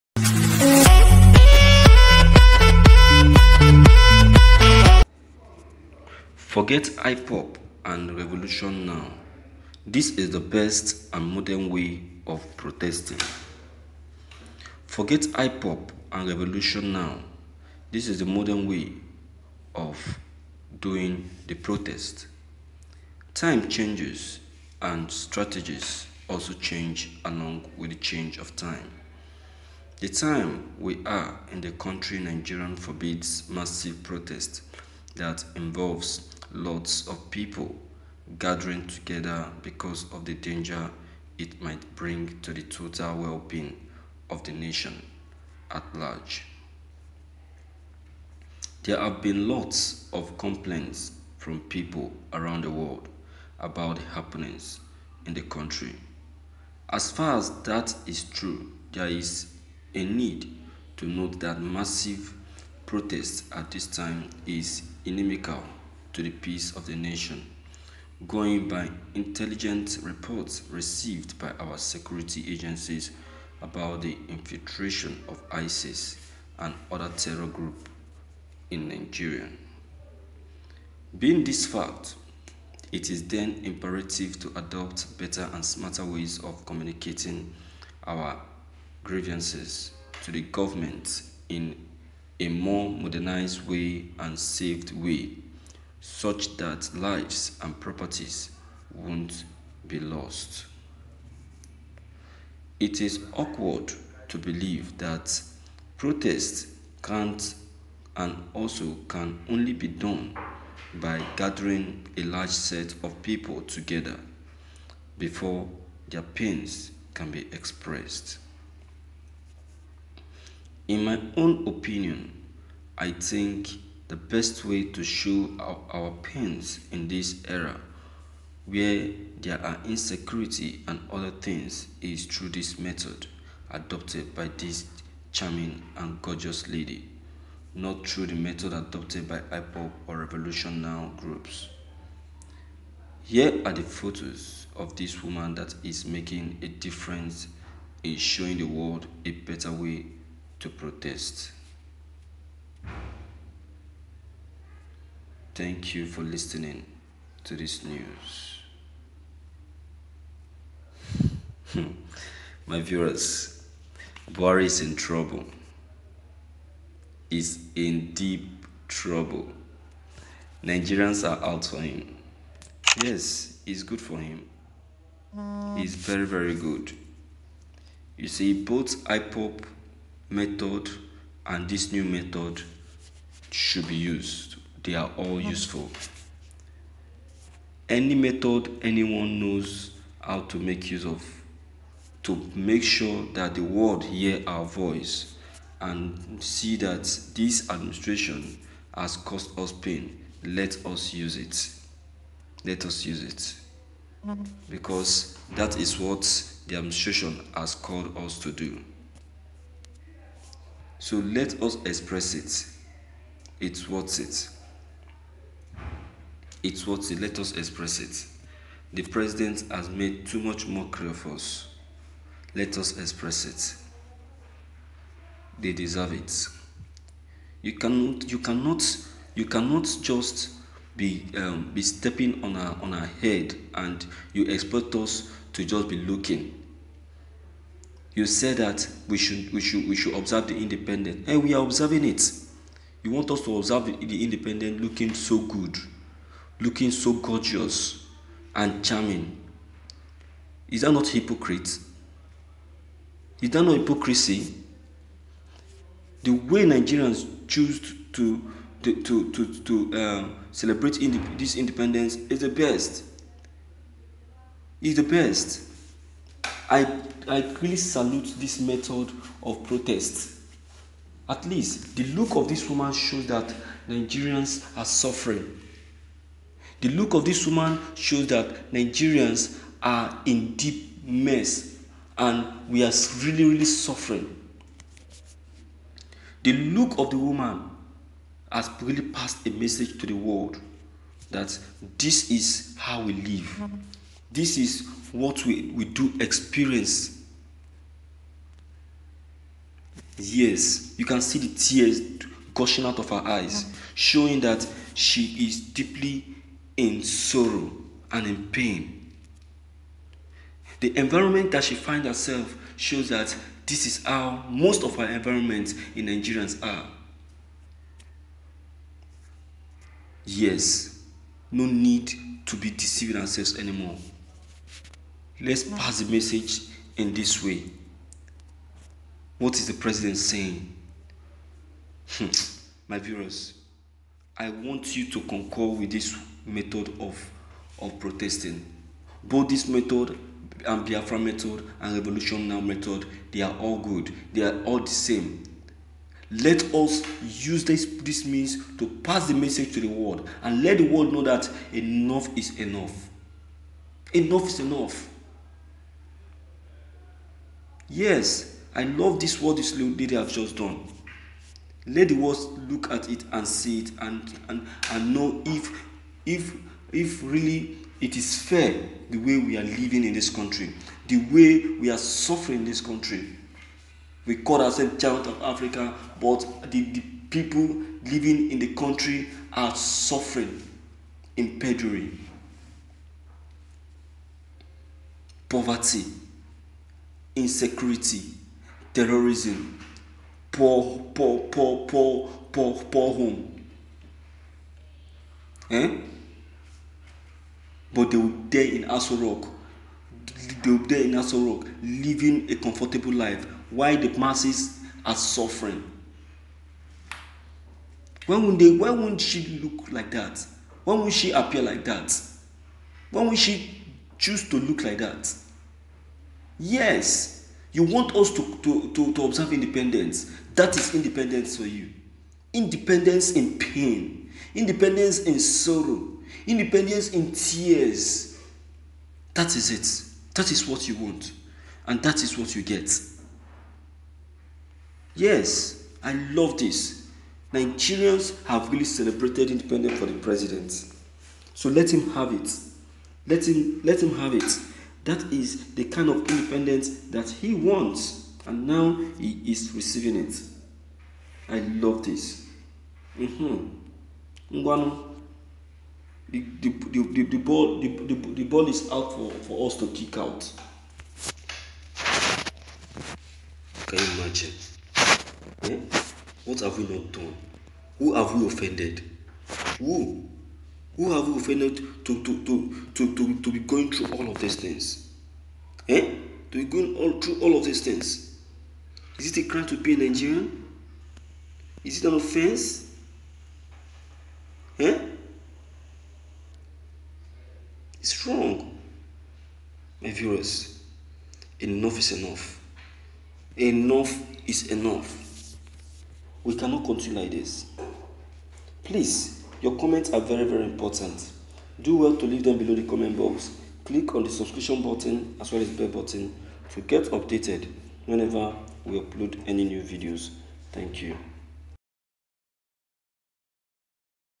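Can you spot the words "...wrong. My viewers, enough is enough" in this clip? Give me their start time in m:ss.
8:08.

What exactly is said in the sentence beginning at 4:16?
The way Nigerians choose to, to, to, to, to um, celebrate this independence is the best.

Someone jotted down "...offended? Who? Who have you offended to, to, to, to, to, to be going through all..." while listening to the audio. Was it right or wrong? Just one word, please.
right.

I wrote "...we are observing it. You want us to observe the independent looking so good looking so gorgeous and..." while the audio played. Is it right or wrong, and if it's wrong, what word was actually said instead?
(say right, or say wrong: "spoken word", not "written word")
right.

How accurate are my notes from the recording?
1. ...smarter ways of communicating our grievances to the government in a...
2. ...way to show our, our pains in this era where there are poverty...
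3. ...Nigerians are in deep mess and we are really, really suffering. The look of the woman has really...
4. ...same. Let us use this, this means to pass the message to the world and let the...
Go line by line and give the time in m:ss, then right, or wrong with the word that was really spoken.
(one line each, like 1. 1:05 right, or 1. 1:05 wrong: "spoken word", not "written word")
1. 1:25 right
2. 2:04 wrong: "insecurity", not "poverty"
3. 4:38 right
4. 5:44 right.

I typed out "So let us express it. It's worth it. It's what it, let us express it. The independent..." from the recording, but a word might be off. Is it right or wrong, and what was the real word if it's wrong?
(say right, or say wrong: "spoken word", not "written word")
wrong: "president", not "independent".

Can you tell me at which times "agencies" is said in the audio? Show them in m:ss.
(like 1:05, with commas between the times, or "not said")
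1:12.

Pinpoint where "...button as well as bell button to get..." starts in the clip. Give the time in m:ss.
8:24.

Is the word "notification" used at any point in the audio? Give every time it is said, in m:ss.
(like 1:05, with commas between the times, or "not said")
not said.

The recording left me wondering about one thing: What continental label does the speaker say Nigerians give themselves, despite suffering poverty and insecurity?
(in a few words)
child of Africa.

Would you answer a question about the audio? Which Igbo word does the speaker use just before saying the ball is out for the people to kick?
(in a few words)
Ngwanu.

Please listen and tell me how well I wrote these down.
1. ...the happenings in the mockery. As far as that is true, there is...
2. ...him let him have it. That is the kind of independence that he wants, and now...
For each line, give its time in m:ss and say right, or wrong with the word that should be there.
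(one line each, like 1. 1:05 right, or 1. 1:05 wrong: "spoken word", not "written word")
1. 0:53 wrong: "country", not "mockery"
2. 7:23 right.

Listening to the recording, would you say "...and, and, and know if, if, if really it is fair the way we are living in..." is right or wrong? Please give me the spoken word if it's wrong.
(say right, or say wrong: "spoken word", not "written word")
right.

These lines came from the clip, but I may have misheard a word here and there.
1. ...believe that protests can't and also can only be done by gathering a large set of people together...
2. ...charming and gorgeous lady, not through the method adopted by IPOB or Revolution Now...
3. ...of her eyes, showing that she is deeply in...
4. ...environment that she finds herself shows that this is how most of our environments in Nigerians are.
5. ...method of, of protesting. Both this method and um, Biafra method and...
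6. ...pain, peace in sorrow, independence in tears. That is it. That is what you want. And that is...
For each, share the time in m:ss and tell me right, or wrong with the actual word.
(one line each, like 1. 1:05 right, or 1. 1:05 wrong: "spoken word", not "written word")
1. 1:44 right
2. 2:15 right
3. 5:02 right
4. 5:10 right
5. 5:36 right
6. 7:03 wrong: "independence", not "peace".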